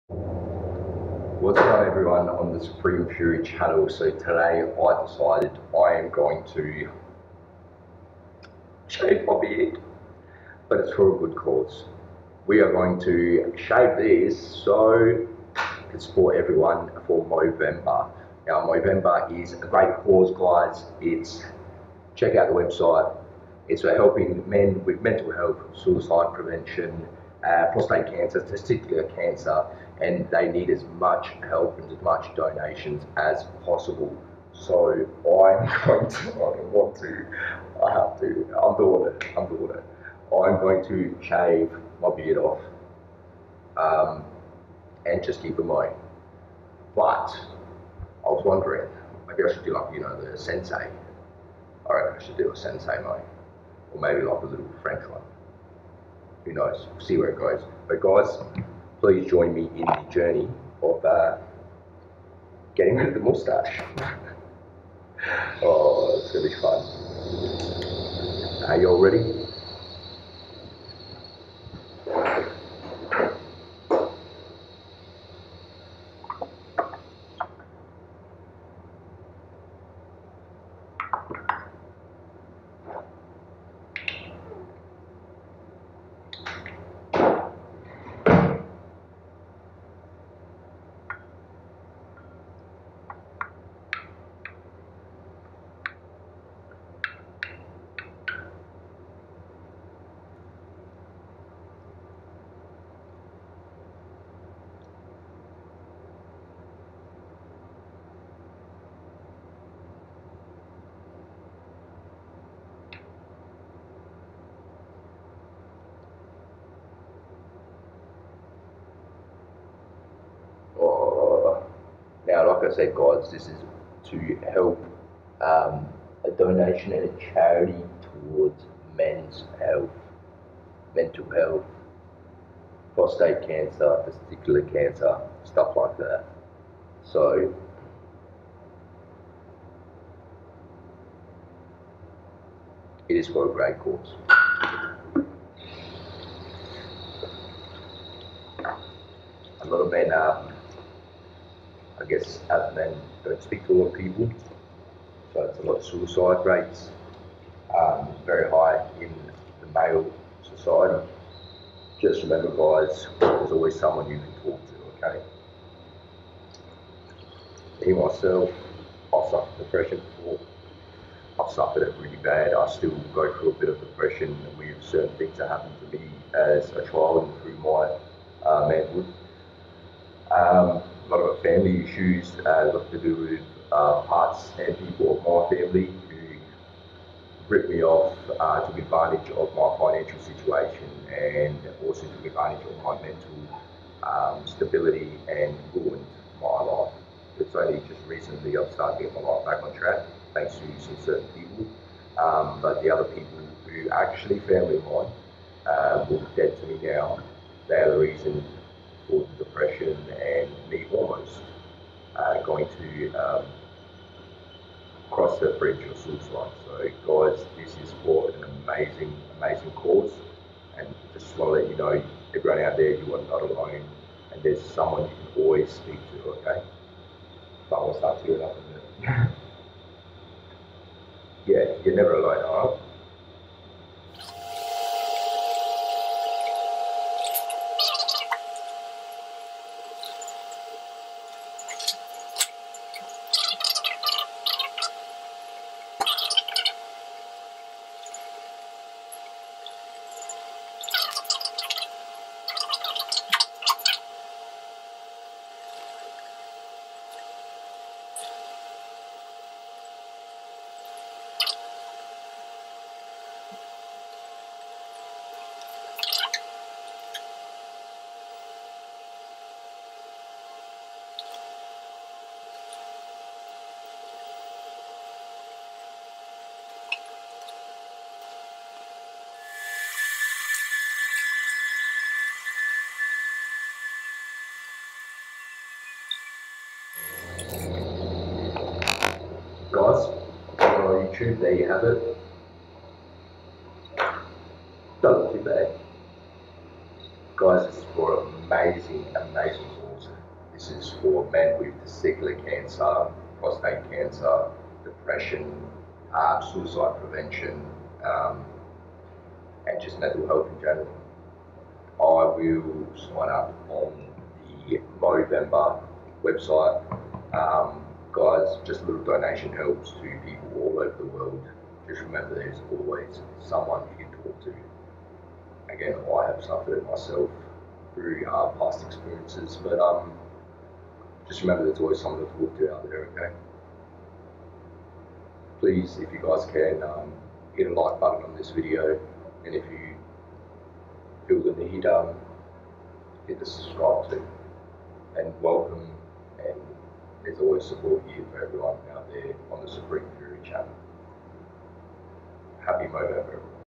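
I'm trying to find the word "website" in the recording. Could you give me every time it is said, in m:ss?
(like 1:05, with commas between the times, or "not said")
0:22, 5:16.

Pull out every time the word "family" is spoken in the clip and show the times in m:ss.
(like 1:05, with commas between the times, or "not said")
3:01, 3:05, 3:24.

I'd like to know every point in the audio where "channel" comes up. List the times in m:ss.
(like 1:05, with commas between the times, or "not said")
0:03, 5:50.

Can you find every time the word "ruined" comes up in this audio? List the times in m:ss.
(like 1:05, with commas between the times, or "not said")
3:15.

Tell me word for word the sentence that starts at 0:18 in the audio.
Now Movember is a great cause guys.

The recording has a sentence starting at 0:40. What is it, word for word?
I'm going to shave my beard off um, and just keep it mind.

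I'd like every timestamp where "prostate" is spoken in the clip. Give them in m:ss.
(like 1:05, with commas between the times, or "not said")
0:27, 2:12, 5:03.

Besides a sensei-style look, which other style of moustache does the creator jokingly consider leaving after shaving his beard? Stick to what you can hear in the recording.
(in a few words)
French.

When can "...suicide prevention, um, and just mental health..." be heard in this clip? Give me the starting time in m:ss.
5:06.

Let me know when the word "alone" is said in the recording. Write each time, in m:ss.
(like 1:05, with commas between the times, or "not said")
3:43, 3:52.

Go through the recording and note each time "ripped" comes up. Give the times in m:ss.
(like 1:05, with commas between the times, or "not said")
3:07.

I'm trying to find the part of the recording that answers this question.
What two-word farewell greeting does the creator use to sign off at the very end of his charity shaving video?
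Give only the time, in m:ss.
5:52.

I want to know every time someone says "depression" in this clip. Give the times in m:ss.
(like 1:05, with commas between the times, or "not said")
2:49, 2:53, 3:29, 5:04.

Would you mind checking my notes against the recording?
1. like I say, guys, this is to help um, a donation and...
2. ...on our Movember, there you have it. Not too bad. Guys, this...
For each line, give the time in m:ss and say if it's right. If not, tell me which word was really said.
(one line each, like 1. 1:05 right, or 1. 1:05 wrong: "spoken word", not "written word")
1. 2:02 right
2. 4:50 wrong: "YouTube", not "Movember".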